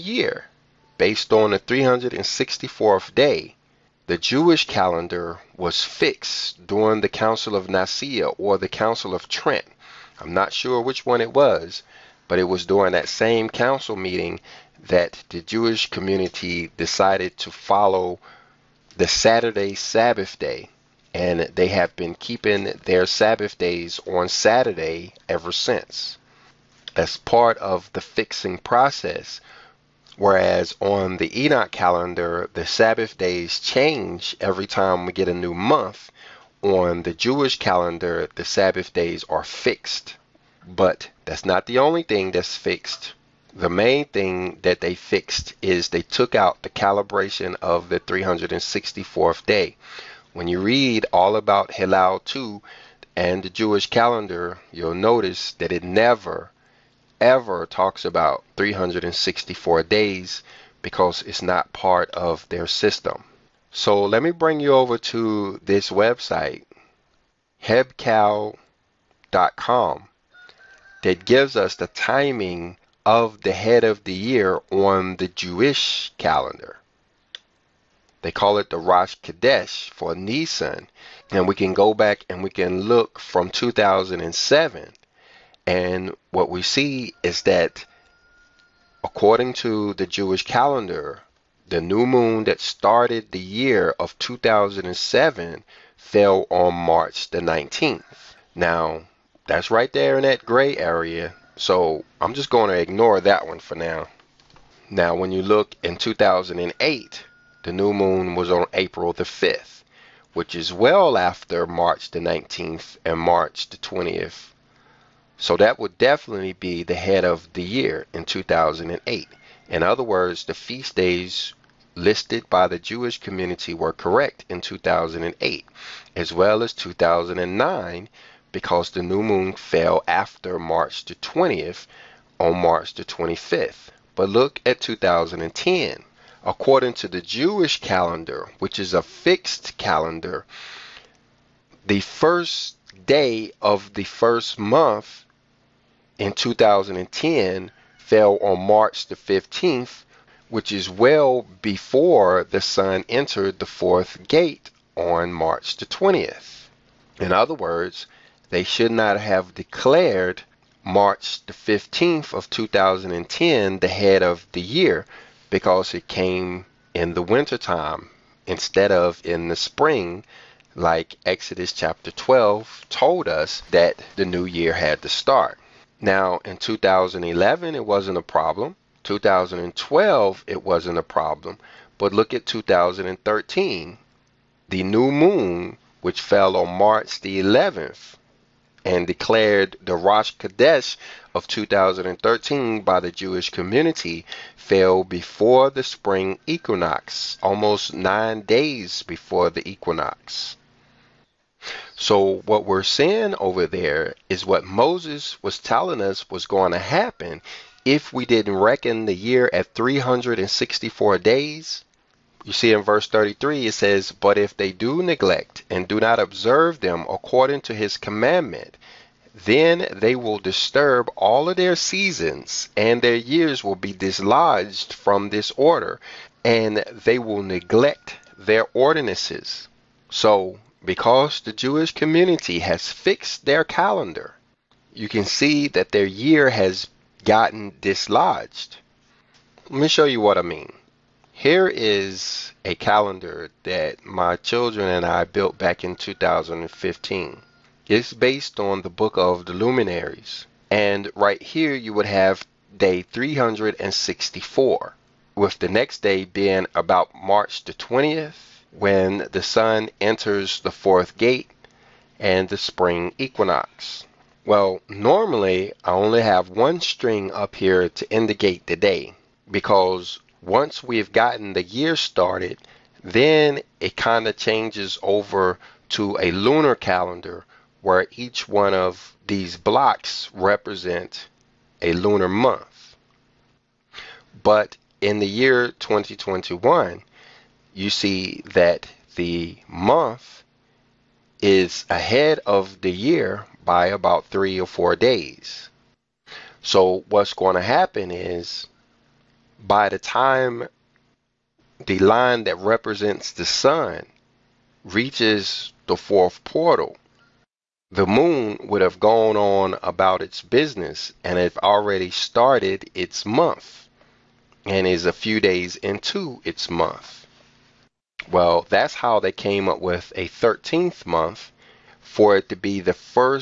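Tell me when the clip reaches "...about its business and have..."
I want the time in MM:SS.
05:09.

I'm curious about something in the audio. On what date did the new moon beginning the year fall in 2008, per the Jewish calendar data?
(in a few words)
April 5.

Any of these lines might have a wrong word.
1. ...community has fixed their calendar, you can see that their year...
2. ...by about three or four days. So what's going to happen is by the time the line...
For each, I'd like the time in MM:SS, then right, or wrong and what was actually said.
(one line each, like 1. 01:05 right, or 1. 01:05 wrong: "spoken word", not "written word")
1. 03:51 right
2. 04:53 right.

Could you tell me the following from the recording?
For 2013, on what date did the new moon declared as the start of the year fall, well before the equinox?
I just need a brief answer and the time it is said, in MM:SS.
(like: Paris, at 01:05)
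March 11, at 03:06.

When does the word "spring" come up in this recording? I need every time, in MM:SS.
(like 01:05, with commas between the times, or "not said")
02:49, 03:15, 04:22.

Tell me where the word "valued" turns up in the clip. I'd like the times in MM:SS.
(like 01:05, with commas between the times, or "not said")
not said.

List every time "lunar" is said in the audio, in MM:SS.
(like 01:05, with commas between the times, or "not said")
04:36, 04:41.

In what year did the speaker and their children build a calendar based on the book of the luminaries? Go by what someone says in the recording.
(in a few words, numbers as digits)
2015.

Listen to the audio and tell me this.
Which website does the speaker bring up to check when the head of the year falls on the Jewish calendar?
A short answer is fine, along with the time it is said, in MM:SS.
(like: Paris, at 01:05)
hebcal.com, at 01:07.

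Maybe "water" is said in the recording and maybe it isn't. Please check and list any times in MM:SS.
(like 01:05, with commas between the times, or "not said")
not said.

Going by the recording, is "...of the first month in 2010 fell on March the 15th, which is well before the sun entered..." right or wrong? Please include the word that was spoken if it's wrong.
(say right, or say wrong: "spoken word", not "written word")
right.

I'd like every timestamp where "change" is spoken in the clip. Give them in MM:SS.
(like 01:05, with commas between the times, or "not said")
00:33, 04:34.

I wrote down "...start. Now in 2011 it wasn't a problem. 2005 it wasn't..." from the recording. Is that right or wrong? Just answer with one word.
wrong.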